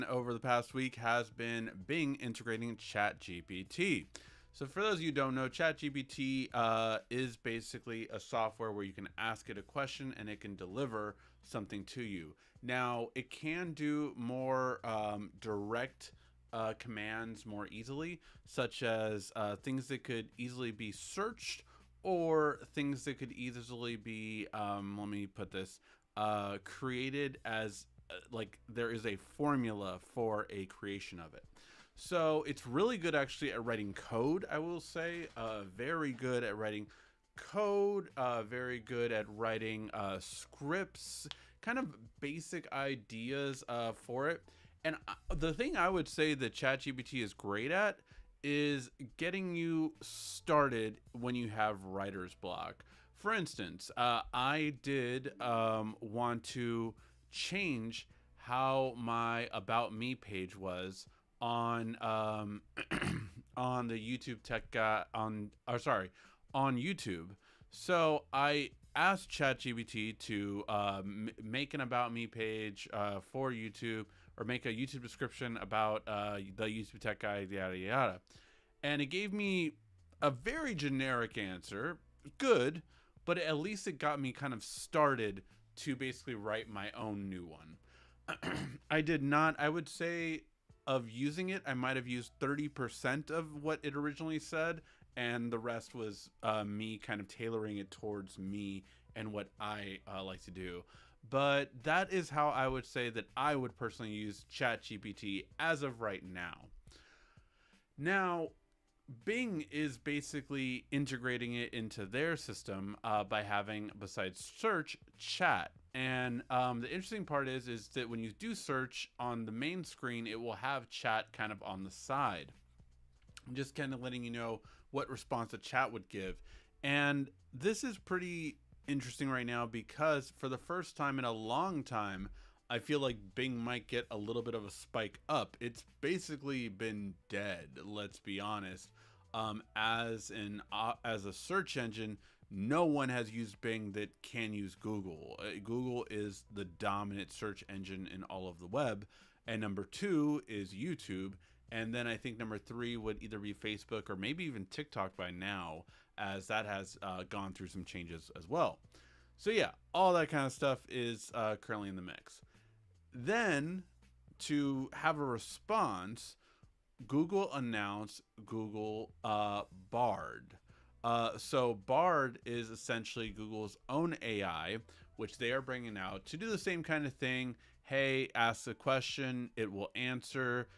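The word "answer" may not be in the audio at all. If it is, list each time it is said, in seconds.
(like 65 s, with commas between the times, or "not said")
81 s, 179 s.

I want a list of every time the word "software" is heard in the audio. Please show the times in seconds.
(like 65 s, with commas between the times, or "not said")
8 s.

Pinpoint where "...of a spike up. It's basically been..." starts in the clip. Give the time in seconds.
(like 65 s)
134 s.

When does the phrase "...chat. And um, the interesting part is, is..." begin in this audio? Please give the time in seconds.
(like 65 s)
115 s.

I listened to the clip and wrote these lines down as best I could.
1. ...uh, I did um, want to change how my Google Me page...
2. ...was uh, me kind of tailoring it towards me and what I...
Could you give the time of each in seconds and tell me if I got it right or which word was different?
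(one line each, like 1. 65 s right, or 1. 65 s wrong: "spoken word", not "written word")
1. 53 s wrong: "About", not "Google"
2. 95 s right.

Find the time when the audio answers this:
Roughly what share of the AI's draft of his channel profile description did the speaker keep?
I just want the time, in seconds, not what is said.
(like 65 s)
92 s.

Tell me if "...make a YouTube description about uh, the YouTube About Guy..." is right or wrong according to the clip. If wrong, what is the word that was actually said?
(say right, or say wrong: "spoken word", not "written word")
wrong: "Tech", not "About".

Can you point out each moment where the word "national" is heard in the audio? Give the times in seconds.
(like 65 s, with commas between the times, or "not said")
not said.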